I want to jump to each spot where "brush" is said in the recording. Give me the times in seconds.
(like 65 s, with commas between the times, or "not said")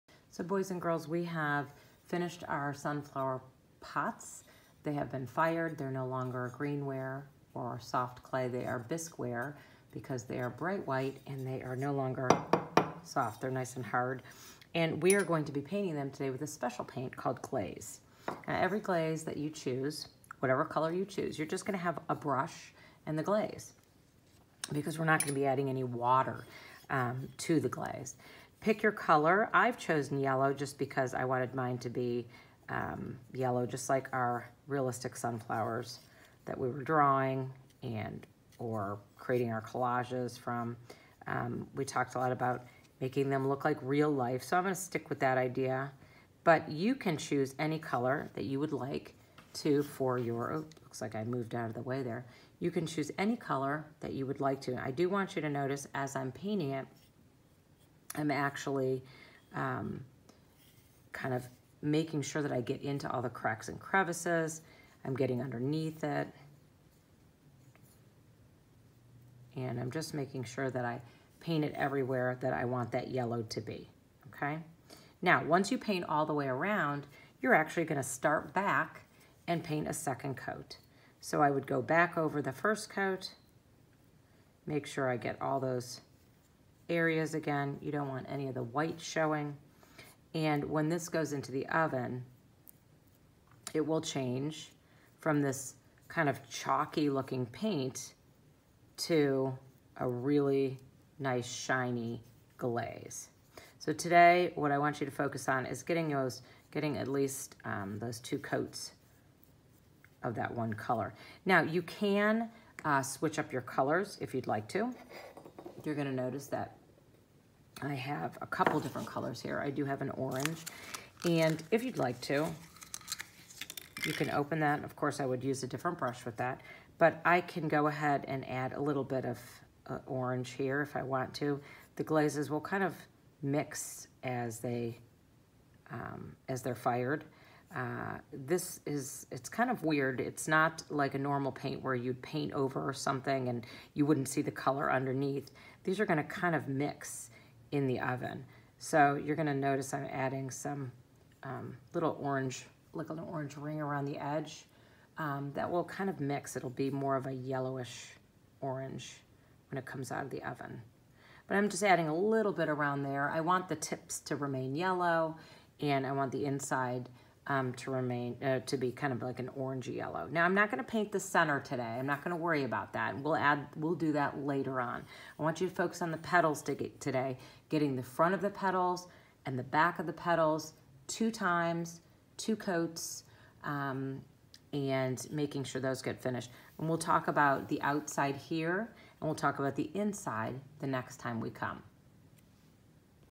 22 s, 125 s.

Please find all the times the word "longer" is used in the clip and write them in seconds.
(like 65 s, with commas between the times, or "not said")
6 s, 11 s.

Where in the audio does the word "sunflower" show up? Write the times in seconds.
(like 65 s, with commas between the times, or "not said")
2 s, 35 s.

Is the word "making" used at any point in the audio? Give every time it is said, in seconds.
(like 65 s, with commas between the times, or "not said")
42 s, 61 s, 70 s, 185 s.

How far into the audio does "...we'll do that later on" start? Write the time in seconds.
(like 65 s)
173 s.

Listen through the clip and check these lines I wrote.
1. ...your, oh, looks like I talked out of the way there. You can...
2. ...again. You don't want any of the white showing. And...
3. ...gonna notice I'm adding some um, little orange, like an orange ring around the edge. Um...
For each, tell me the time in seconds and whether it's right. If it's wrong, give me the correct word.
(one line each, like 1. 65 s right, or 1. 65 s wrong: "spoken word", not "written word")
1. 50 s wrong: "moved", not "talked"
2. 87 s right
3. 149 s right.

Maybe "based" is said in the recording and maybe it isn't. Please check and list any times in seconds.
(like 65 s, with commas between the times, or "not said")
not said.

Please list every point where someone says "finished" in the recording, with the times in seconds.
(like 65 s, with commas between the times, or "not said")
2 s, 186 s.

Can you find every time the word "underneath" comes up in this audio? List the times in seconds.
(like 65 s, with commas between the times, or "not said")
65 s, 144 s.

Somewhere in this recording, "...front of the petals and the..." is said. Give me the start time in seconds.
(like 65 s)
178 s.